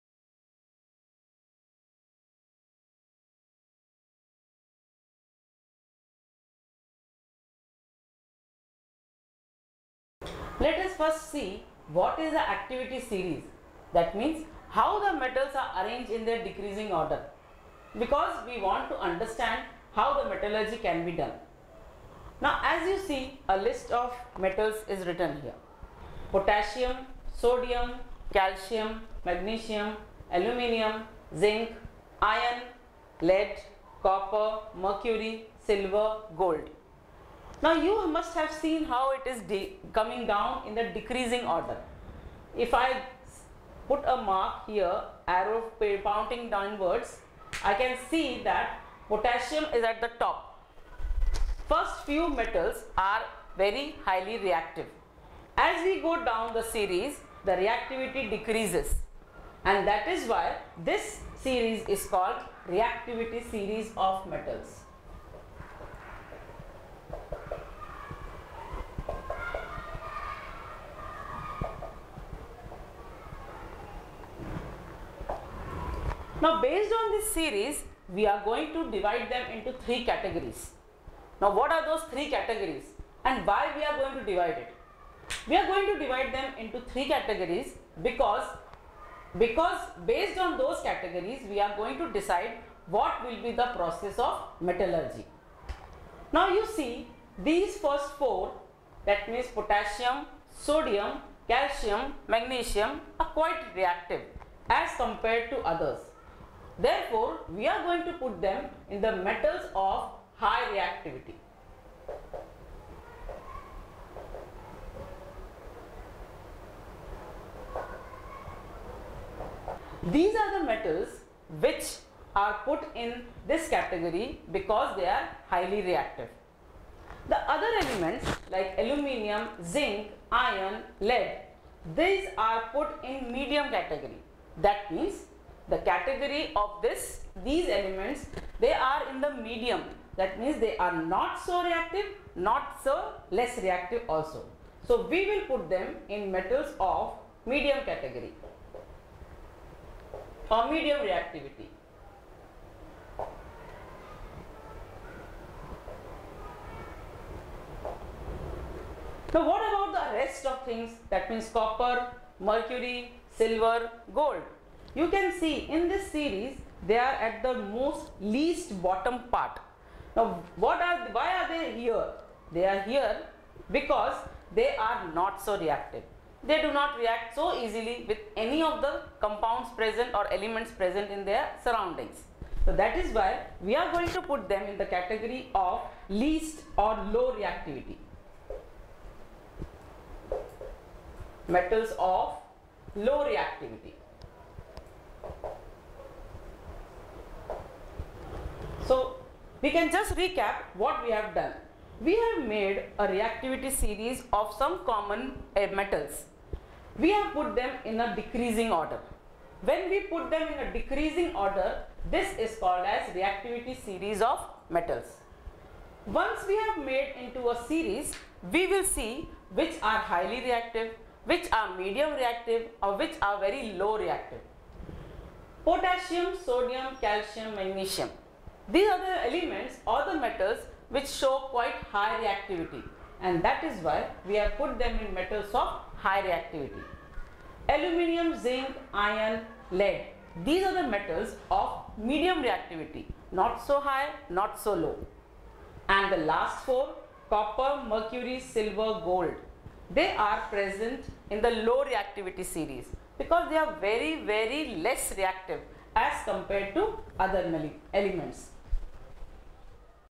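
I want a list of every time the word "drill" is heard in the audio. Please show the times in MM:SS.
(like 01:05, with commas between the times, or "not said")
not said.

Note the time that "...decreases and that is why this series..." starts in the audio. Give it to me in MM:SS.
00:58.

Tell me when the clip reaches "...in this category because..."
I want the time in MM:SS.
02:02.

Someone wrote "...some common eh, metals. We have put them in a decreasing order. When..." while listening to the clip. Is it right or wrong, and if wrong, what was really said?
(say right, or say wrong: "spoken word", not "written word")
right.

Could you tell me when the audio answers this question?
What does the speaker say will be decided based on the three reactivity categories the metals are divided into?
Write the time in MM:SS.
01:33.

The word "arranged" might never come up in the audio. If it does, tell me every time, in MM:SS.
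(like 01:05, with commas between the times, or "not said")
00:15.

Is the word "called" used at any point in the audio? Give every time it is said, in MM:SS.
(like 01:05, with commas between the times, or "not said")
01:02, 03:32.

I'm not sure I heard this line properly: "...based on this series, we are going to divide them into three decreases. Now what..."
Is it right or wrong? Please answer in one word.
wrong.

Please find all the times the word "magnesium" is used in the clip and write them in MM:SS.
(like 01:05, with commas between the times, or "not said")
00:29, 01:42, 03:47.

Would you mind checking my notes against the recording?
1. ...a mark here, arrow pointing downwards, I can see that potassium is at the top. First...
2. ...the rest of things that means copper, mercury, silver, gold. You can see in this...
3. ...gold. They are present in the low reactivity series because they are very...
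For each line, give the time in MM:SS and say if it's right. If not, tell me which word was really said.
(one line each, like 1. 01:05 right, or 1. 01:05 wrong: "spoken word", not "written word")
1. 00:44 right
2. 02:39 right
3. 04:09 right.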